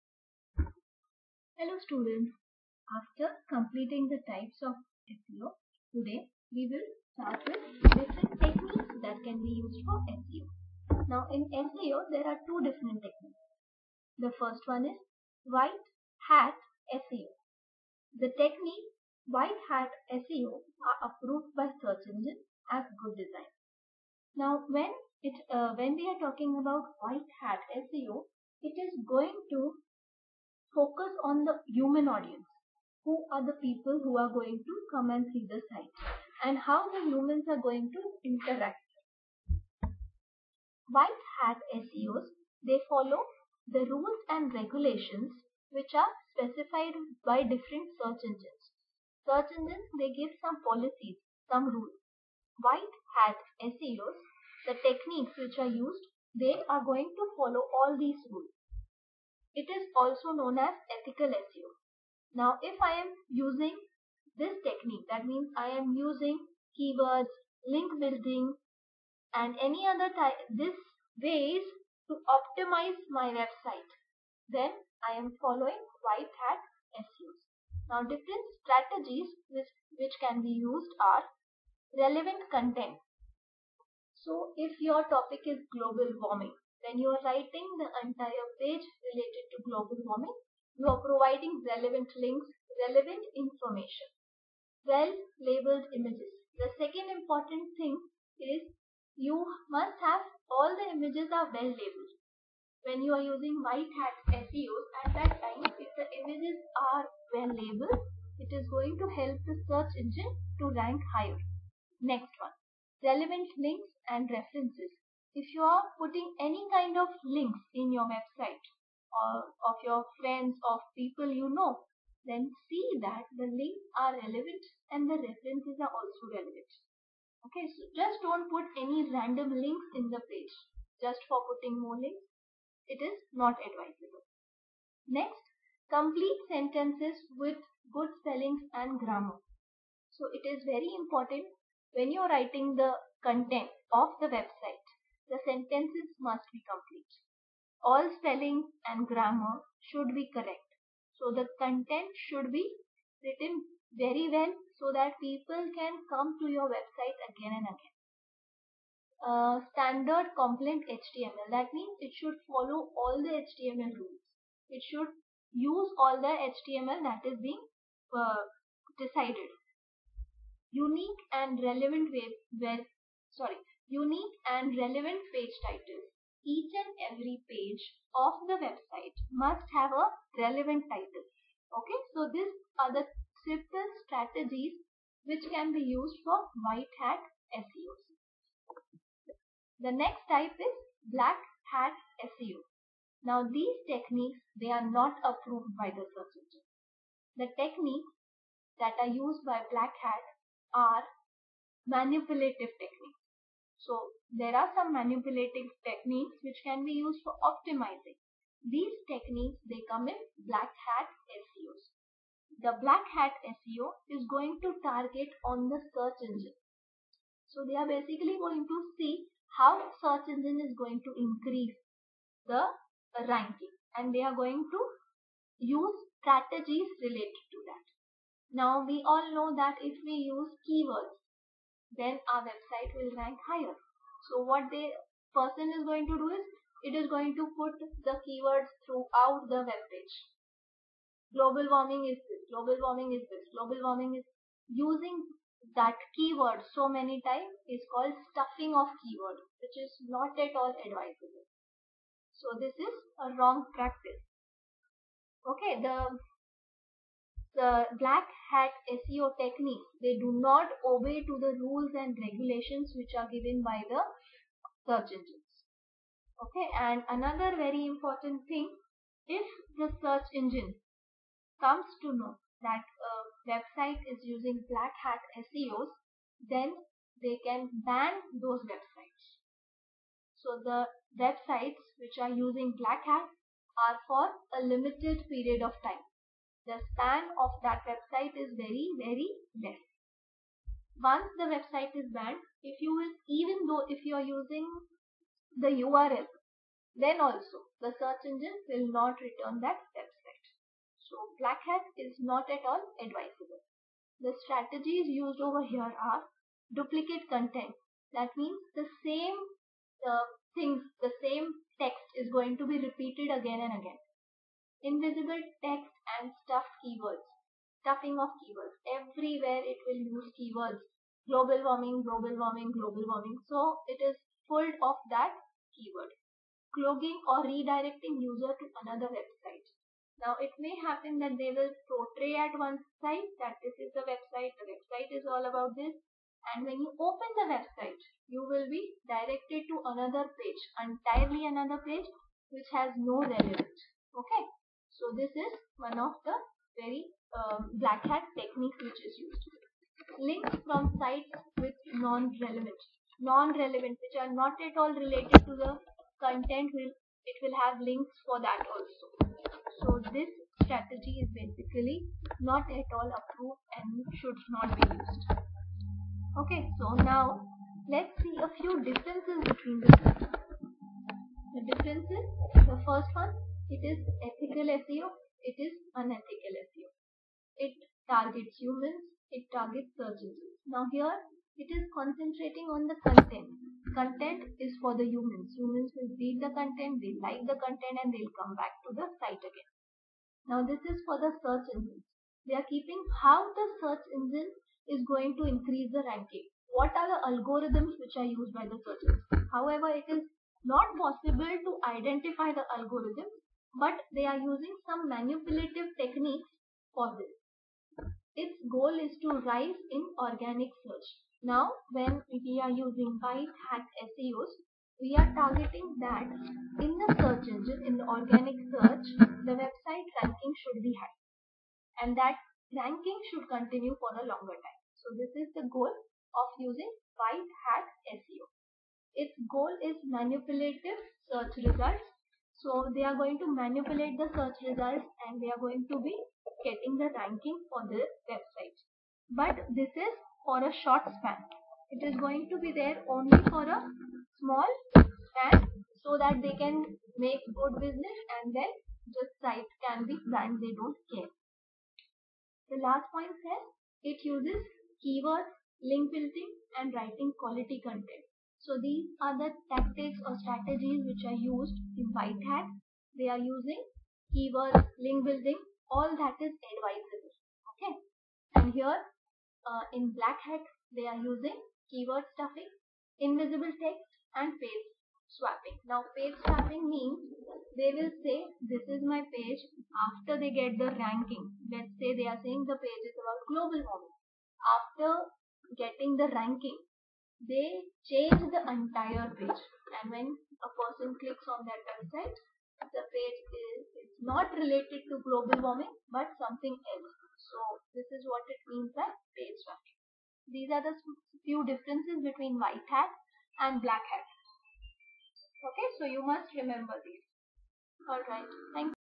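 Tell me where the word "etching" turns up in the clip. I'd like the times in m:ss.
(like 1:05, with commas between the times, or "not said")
not said.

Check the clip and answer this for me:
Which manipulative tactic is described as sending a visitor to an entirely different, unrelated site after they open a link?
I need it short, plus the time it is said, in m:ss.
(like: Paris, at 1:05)
cloaking, at 5:26.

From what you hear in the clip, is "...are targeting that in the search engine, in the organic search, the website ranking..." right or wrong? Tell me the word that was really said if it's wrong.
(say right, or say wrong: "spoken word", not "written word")
right.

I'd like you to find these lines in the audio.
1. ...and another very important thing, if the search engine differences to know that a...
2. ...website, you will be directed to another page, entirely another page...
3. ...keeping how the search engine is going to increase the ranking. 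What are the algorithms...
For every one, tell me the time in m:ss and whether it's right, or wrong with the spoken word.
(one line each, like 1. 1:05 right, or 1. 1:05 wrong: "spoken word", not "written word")
1. 4:26 wrong: "comes", not "differences"
2. 5:37 right
3. 6:32 right.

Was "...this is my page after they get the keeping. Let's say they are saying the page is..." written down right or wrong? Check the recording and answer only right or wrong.
wrong.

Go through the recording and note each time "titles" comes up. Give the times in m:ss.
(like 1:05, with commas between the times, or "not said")
2:55, 3:00.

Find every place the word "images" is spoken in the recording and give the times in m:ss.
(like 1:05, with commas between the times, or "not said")
1:35, 1:40, 1:46.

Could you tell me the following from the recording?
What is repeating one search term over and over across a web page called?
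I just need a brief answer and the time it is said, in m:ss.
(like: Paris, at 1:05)
stuffing of keyword, at 4:08.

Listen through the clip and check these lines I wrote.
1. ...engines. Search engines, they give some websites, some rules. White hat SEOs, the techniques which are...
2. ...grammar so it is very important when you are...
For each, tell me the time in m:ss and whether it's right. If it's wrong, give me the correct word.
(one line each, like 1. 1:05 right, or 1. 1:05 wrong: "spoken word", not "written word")
1. 0:48 wrong: "policies", not "websites"
2. 2:18 right.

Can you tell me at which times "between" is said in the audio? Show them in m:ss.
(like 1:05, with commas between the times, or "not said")
6:09, 8:22.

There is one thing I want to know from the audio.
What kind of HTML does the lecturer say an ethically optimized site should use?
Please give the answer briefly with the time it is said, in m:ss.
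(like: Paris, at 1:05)
standard compliant HTML, at 2:39.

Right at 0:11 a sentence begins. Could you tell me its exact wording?
Now in SEO there are two different techniques.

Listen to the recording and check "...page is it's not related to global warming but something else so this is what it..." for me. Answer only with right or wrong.
right.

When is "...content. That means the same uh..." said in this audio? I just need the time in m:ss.
5:07.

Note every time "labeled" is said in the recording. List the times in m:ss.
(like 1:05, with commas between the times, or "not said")
1:35, 1:41, 1:47.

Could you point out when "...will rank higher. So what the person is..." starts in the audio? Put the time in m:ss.
3:52.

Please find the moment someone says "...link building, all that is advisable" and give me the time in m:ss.
7:45.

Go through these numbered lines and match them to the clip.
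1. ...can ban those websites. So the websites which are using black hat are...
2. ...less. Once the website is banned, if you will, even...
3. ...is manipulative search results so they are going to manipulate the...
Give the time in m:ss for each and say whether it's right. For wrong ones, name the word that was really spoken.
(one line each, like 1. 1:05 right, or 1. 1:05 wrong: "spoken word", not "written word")
1. 4:37 right
2. 4:49 right
3. 7:09 right.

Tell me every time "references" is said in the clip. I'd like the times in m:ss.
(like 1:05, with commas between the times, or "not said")
1:54, 2:05.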